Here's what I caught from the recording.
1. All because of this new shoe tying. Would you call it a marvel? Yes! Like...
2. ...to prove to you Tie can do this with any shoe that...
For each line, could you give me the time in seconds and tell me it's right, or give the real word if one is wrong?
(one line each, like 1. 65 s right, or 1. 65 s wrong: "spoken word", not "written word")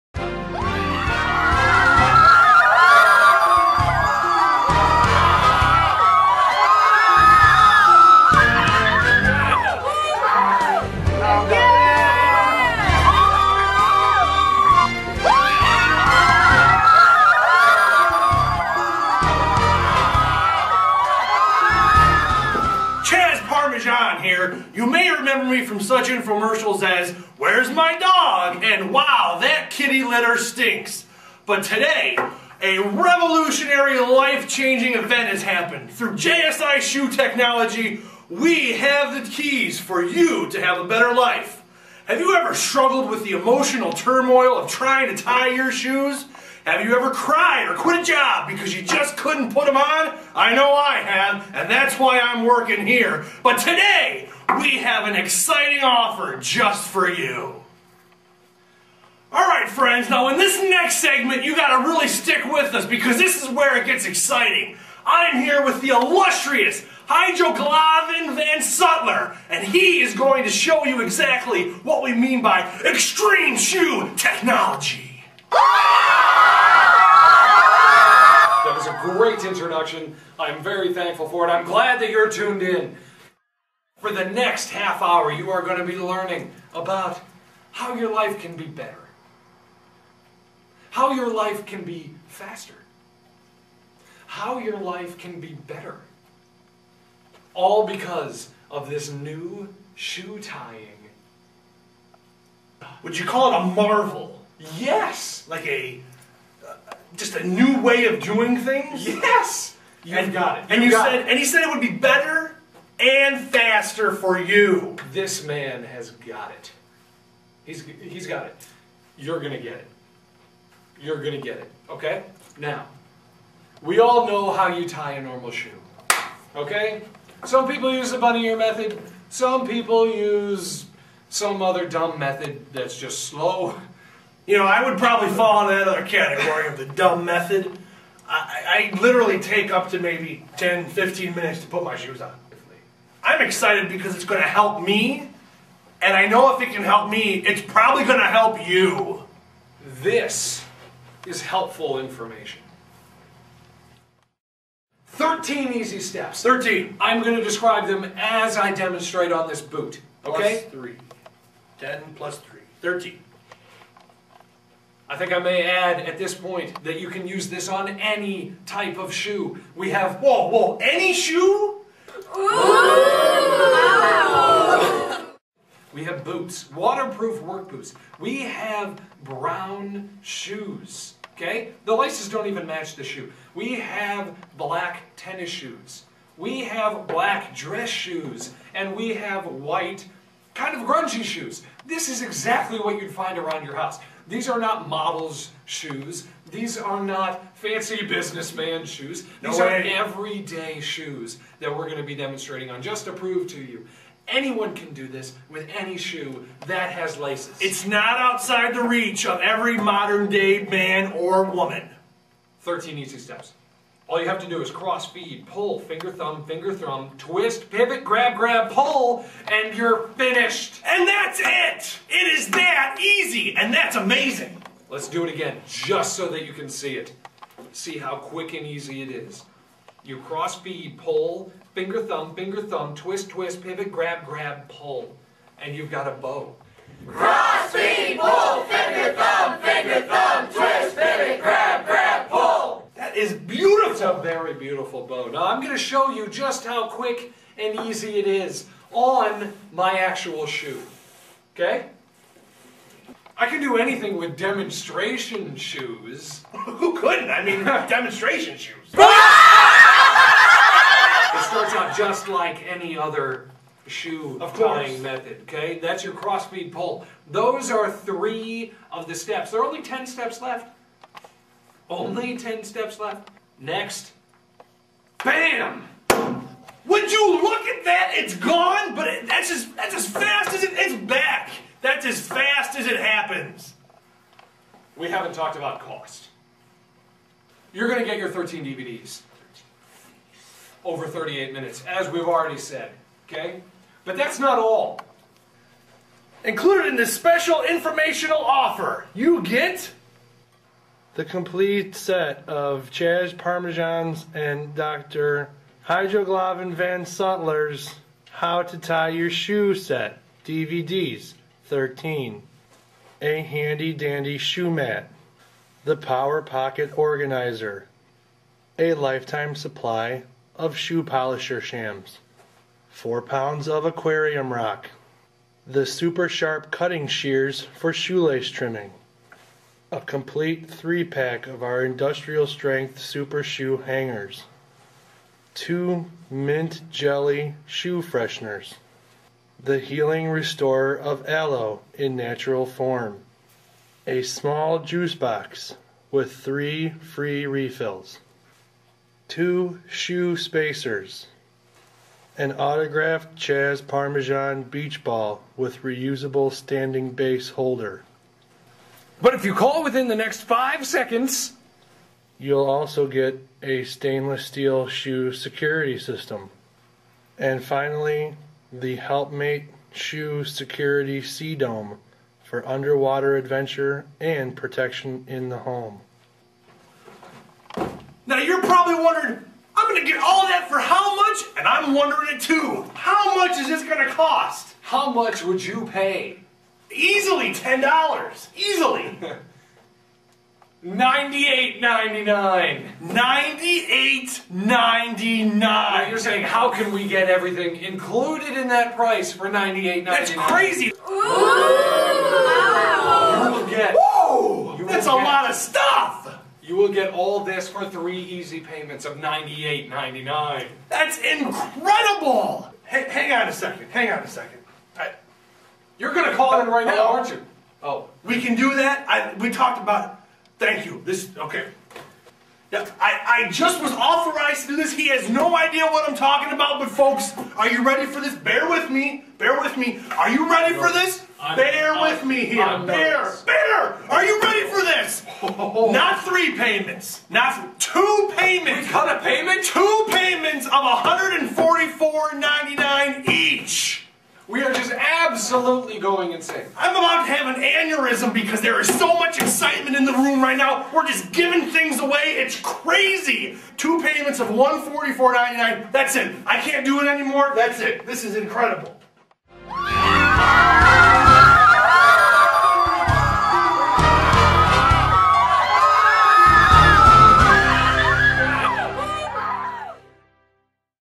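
1. 97 s right
2. 203 s wrong: "Anyone", not "Tie".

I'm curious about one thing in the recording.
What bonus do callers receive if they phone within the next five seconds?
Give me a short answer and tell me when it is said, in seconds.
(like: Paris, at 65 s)
stainless steel shoe security system, at 363 s.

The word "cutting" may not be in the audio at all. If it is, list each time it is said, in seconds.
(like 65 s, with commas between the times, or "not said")
326 s.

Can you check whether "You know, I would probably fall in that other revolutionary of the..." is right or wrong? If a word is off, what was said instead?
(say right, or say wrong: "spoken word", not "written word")
wrong: "category", not "revolutionary".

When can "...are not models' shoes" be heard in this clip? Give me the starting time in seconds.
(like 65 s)
194 s.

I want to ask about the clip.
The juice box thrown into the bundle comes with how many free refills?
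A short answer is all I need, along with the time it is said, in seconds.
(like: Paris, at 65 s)
3, at 346 s.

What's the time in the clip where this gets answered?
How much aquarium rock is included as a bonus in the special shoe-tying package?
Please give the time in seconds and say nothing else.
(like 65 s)
322 s.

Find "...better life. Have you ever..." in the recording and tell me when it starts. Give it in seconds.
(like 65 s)
40 s.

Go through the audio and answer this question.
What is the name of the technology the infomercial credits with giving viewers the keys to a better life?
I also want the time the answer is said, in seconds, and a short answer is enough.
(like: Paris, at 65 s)
JSI Shoe Technology, at 36 s.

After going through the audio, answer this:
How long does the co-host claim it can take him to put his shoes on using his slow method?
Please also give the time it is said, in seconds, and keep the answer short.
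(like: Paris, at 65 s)
10 to 15 minutes, at 140 s.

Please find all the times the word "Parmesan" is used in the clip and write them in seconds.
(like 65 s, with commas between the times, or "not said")
303 s, 353 s.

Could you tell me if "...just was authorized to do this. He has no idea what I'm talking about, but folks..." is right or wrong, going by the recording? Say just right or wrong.
right.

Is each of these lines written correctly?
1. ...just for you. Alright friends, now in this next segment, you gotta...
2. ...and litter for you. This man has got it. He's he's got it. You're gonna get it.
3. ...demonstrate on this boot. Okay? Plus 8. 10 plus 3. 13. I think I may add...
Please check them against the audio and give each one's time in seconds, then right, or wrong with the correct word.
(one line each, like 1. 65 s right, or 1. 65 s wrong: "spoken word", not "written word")
1. 56 s right
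2. 112 s wrong: "faster", not "litter"
3. 158 s wrong: "3", not "8".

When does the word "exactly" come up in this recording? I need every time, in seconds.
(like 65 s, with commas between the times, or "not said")
71 s, 192 s.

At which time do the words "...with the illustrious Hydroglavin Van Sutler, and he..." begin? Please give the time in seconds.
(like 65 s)
65 s.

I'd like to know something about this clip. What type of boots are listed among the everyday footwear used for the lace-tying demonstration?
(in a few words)
waterproof work boots.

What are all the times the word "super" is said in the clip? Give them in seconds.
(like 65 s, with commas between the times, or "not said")
325 s, 332 s.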